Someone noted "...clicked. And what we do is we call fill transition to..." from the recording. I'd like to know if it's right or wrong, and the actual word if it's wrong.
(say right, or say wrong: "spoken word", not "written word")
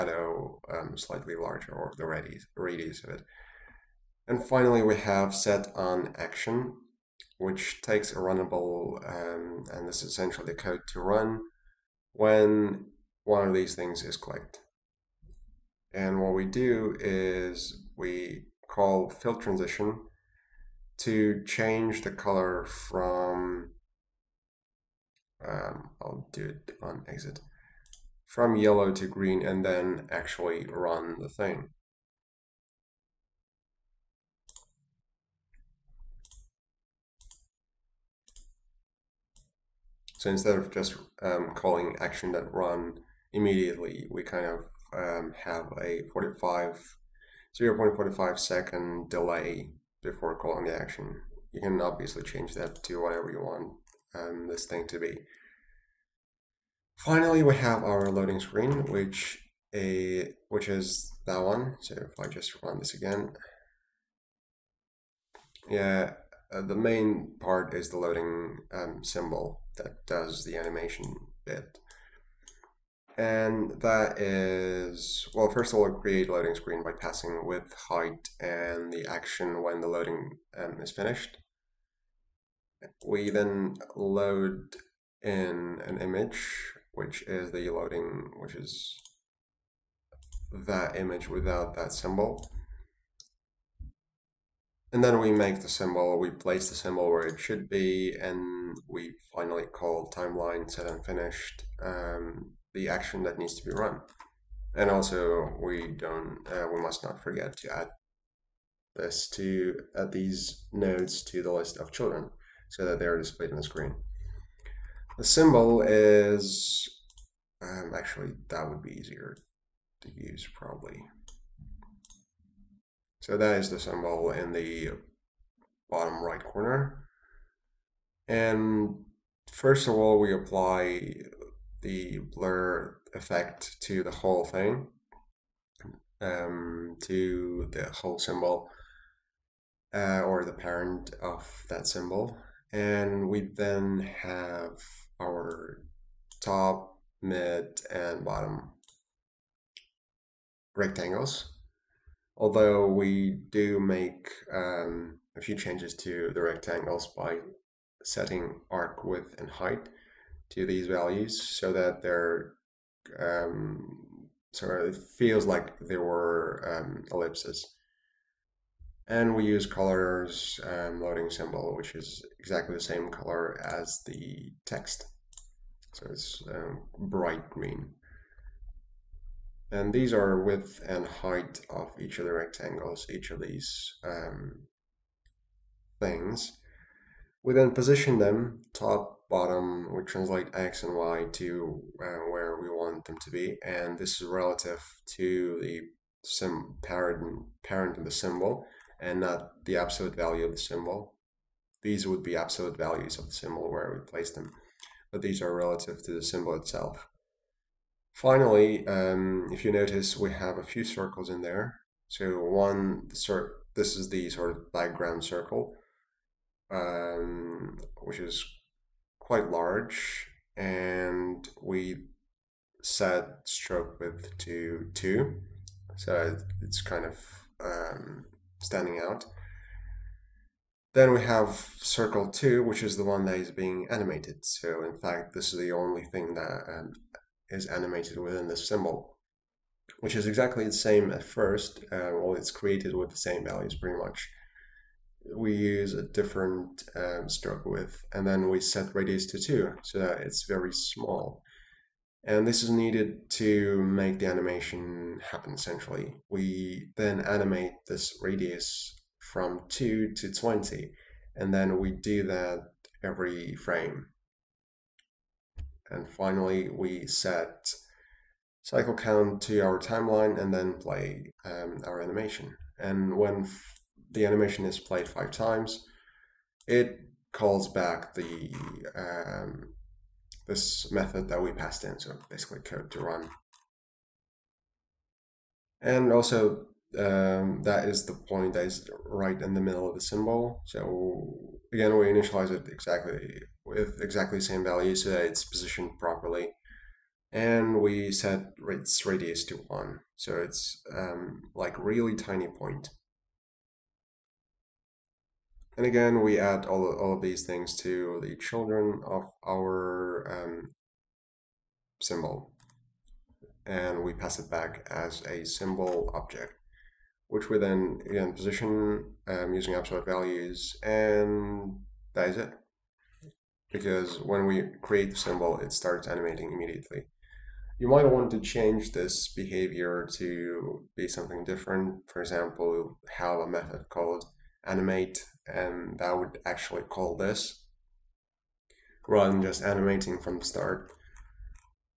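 right.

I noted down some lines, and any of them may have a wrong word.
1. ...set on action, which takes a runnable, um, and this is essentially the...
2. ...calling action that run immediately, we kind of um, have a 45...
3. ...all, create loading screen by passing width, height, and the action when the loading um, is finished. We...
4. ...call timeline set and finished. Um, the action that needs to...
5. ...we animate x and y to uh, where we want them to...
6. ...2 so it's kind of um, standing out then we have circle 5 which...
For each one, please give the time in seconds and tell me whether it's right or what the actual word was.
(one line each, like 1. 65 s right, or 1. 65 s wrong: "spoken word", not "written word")
1. 5 s right
2. 41 s right
3. 75 s right
4. 99 s right
5. 189 s wrong: "translate", not "animate"
6. 224 s wrong: "2", not "5".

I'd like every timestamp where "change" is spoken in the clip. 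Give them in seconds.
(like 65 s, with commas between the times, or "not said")
21 s, 52 s, 155 s, 328 s.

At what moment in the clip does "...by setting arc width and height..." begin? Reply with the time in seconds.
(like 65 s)
157 s.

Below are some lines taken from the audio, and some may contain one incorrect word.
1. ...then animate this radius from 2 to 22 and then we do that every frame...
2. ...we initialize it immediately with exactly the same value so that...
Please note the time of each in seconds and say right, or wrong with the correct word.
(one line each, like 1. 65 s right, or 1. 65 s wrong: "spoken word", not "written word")
1. 256 s wrong: "20", not "22"
2. 291 s wrong: "exactly", not "immediately".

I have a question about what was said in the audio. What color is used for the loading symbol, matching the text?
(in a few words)
bright green.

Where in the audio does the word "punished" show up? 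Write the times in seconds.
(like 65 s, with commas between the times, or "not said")
not said.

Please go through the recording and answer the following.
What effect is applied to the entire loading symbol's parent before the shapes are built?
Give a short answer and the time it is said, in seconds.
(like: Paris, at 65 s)
blur effect, at 132 s.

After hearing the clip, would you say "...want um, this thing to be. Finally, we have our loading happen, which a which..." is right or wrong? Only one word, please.
wrong.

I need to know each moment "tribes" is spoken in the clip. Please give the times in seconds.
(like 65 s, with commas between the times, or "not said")
not said.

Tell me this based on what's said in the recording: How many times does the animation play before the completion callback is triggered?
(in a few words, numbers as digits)
5.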